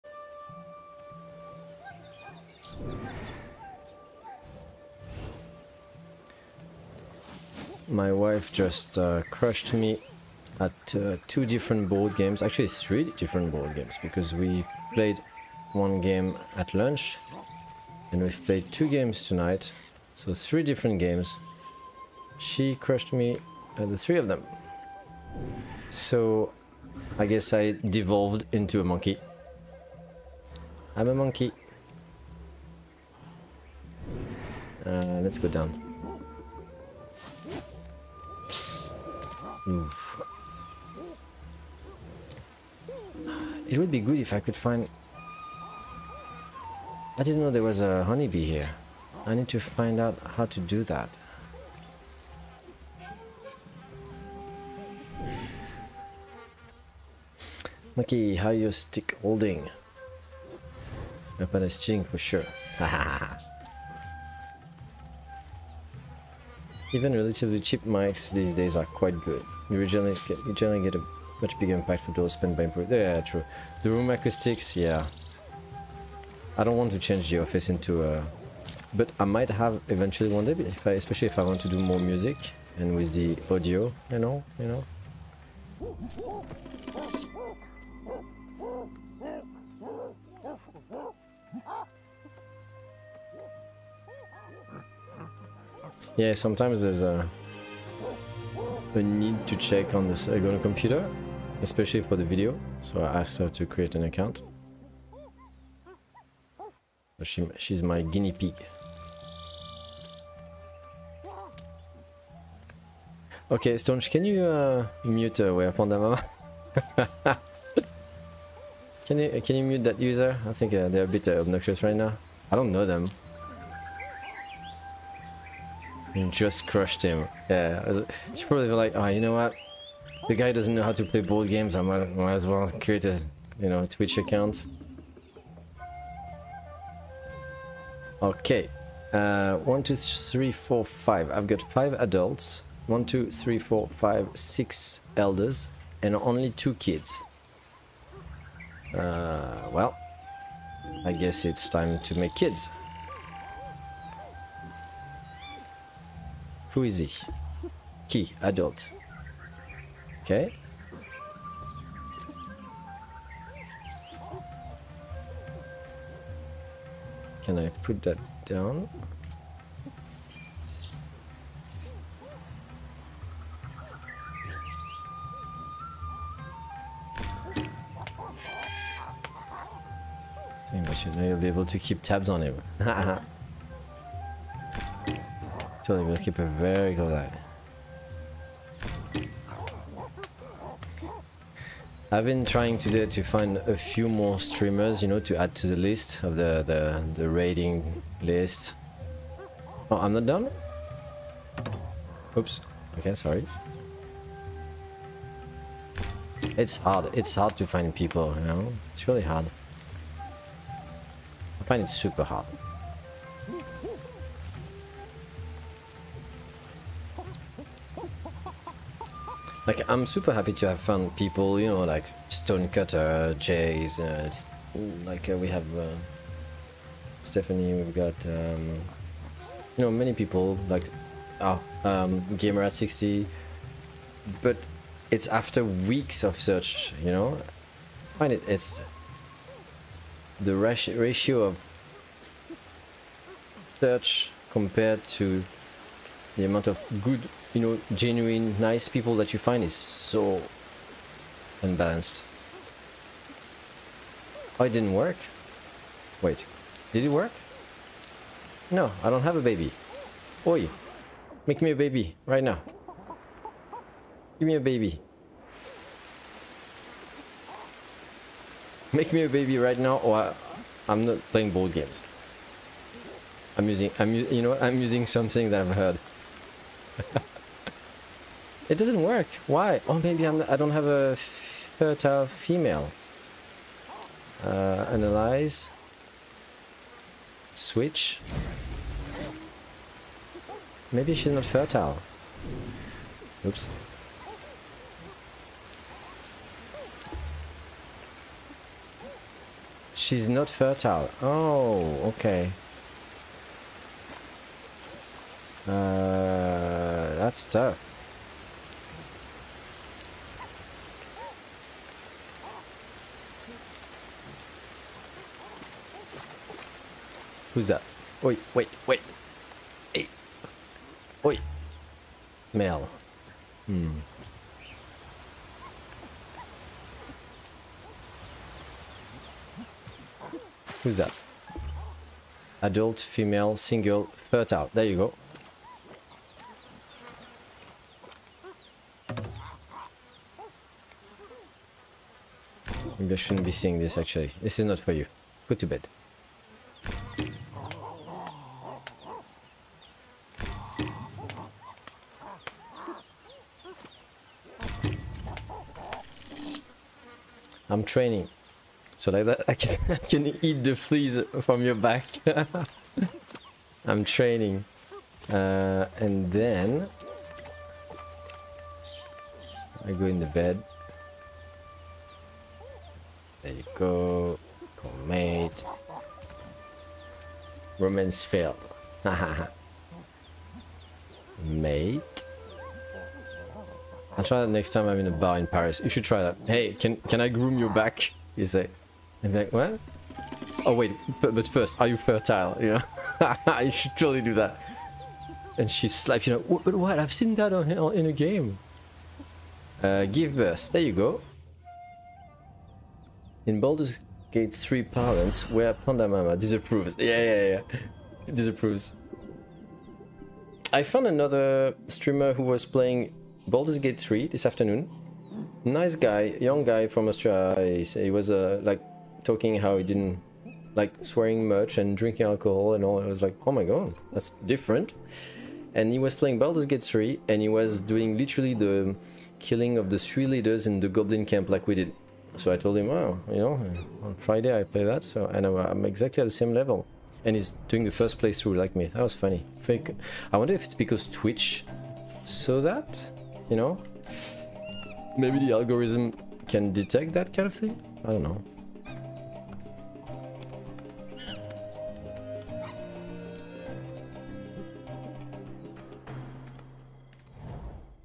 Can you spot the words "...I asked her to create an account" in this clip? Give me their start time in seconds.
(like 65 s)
103 s.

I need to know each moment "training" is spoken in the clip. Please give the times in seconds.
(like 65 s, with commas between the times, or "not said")
357 s, 364 s.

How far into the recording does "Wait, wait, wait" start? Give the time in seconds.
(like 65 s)
318 s.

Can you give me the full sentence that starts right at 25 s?
So, I guess I devolved into a monkey.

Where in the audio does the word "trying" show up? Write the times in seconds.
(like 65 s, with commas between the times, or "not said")
192 s.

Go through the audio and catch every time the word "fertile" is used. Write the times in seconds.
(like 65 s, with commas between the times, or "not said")
281 s, 291 s, 300 s, 334 s, 391 s.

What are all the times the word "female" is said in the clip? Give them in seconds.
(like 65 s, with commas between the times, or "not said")
282 s, 332 s.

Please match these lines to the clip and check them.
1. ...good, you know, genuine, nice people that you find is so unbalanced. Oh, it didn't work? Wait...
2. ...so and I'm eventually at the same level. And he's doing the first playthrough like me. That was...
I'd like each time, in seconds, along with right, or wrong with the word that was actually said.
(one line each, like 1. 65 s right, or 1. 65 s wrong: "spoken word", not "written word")
1. 247 s right
2. 435 s wrong: "exactly", not "eventually".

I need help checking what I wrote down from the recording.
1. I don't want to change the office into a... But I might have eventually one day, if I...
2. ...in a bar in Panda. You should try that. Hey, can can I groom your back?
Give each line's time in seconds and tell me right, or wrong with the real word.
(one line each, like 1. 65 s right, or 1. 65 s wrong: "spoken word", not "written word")
1. 76 s right
2. 384 s wrong: "Paris", not "Panda".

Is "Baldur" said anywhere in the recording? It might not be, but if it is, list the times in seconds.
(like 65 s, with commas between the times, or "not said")
403 s, 413 s, 426 s.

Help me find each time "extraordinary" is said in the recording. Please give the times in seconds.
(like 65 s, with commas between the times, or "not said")
not said.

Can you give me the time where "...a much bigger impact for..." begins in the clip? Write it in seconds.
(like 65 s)
70 s.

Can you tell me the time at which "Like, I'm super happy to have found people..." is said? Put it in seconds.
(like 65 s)
219 s.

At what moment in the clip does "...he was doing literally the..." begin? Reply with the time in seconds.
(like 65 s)
427 s.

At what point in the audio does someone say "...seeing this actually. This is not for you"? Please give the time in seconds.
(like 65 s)
343 s.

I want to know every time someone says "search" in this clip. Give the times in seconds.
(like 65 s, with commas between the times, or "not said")
236 s, 243 s.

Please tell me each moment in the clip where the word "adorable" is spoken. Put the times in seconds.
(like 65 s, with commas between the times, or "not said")
not said.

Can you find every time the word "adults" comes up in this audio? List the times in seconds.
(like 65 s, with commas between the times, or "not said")
141 s, 158 s, 332 s.